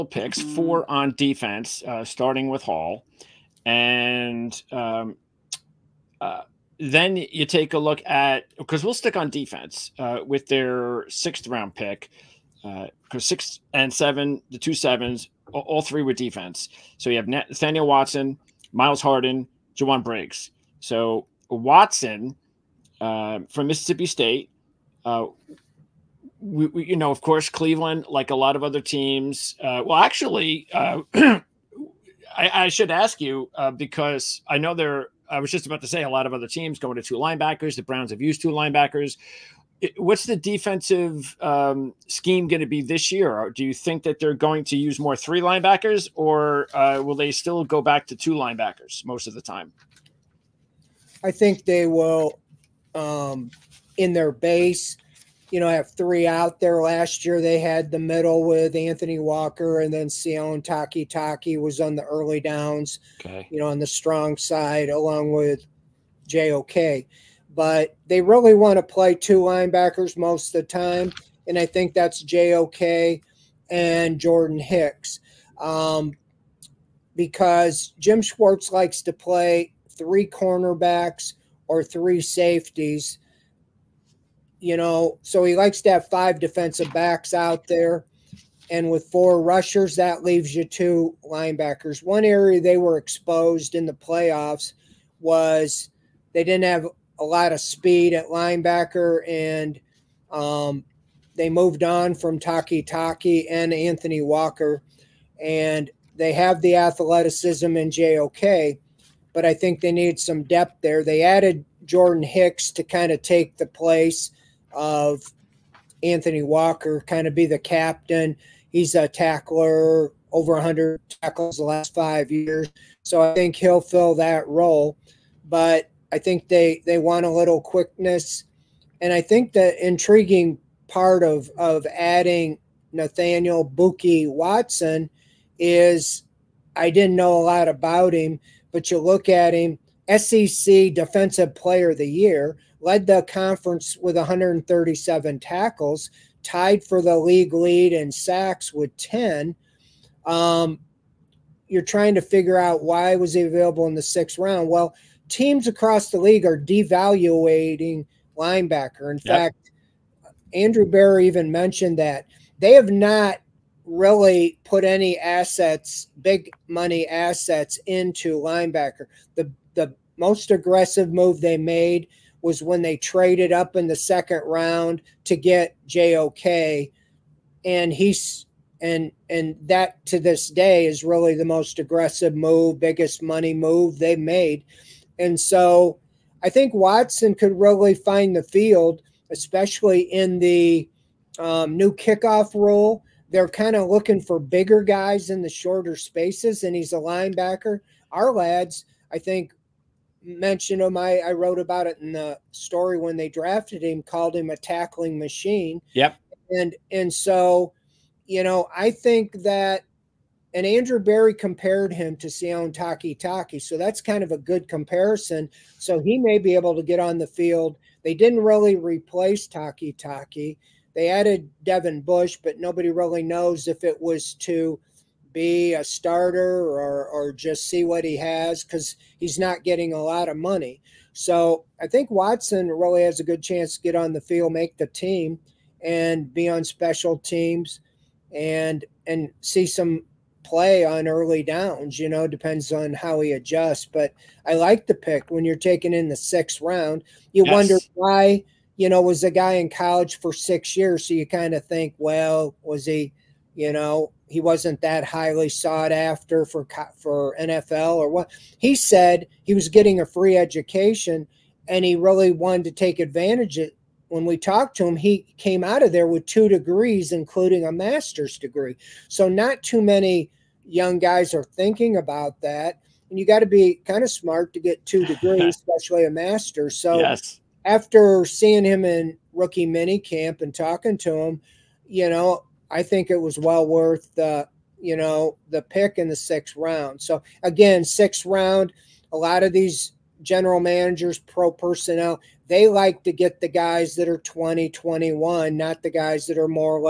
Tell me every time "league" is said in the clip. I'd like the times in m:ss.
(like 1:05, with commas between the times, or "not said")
2:27, 2:36.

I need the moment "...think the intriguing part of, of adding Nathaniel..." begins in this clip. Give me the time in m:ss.
2:09.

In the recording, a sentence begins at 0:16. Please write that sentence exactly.
So you have Nathaniel Watson, Myles Harden, Jowon Briggs.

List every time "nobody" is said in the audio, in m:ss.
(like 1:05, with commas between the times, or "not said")
3:42.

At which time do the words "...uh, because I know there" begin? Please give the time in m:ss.
0:33.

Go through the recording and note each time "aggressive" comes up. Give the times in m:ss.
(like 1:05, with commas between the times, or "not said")
2:50, 3:01.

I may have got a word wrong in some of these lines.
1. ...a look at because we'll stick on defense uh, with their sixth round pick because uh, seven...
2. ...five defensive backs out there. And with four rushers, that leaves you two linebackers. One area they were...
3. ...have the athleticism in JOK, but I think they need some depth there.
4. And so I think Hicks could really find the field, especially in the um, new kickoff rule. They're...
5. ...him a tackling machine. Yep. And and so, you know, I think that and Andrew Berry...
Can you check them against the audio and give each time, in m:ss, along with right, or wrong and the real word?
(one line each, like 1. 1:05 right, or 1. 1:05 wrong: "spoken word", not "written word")
1. 0:07 wrong: "six", not "seven"
2. 1:26 right
3. 1:46 right
4. 3:05 wrong: "Watson", not "Hicks"
5. 3:24 right.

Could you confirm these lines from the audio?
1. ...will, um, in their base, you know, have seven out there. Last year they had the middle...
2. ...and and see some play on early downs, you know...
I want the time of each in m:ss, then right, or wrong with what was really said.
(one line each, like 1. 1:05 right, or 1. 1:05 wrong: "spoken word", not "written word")
1. 0:51 wrong: "three", not "seven"
2. 3:58 right.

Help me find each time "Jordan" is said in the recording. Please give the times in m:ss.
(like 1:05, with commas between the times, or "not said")
1:14, 1:51.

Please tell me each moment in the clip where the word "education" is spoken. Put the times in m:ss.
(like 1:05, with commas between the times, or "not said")
4:20.